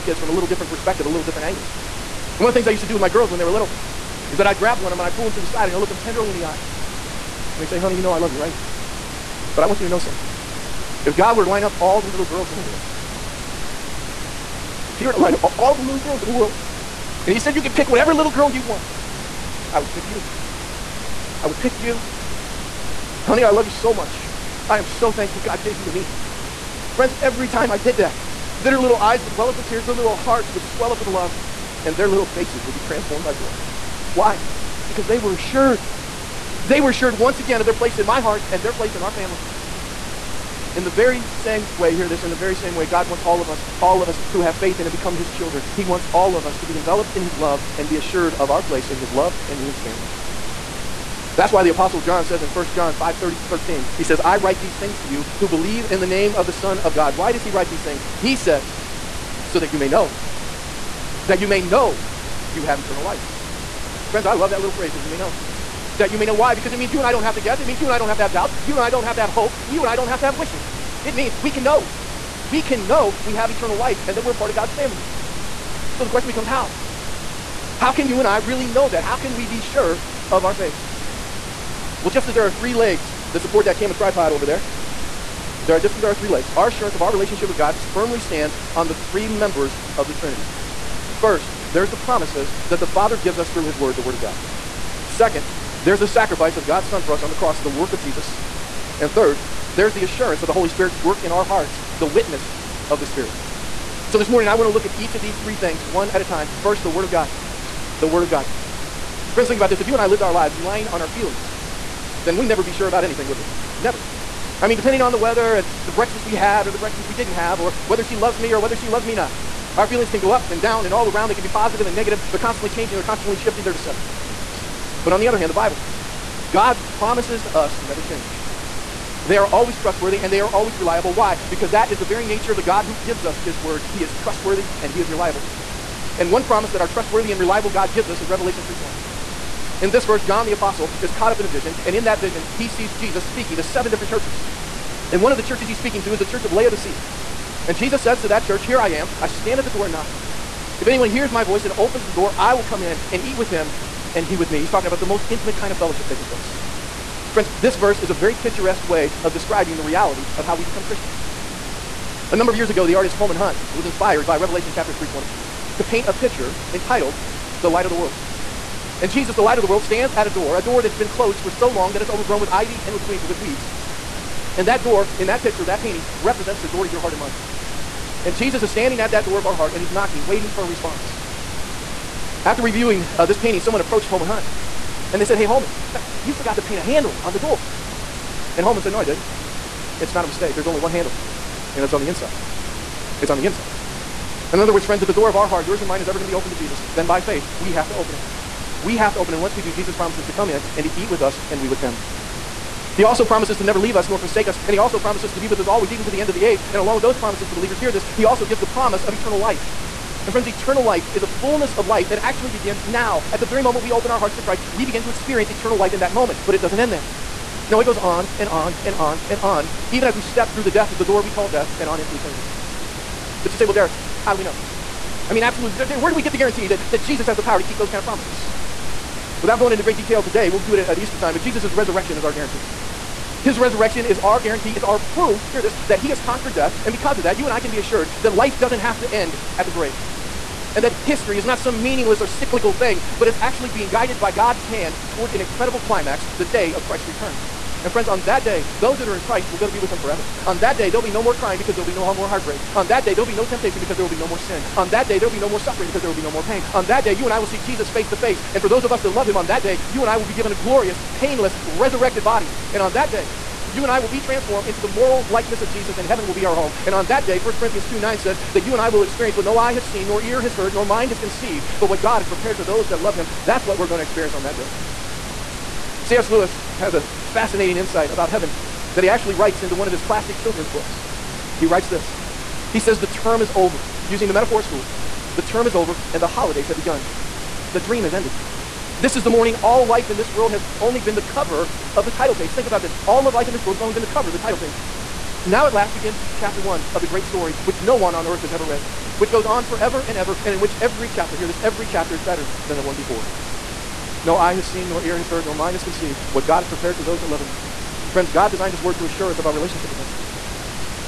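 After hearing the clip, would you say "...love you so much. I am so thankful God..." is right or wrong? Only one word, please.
right.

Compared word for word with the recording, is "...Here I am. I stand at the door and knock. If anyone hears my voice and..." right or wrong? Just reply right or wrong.
right.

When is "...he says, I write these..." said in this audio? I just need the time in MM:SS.
00:53.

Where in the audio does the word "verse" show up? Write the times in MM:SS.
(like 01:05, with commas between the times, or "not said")
02:20, 02:37.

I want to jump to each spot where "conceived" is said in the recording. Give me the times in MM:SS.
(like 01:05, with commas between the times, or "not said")
04:31, 05:05.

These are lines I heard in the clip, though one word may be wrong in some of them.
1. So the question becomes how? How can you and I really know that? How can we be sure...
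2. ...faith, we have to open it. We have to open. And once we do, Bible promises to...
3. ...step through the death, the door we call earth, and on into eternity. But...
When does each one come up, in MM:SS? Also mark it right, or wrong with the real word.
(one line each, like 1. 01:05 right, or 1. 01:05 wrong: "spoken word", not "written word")
1. 01:15 right
2. 03:17 wrong: "Jesus", not "Bible"
3. 03:40 wrong: "death", not "earth".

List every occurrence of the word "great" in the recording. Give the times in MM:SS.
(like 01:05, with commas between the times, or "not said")
03:49, 04:57.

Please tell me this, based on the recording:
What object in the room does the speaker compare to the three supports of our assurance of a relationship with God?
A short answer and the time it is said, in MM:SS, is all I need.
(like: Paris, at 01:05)
camera tripod, at 01:23.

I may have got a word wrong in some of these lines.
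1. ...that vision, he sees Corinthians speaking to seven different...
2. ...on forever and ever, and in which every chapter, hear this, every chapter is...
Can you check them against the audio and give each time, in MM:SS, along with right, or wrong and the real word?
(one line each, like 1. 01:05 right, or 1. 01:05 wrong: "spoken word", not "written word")
1. 02:22 wrong: "Jesus", not "Corinthians"
2. 04:59 right.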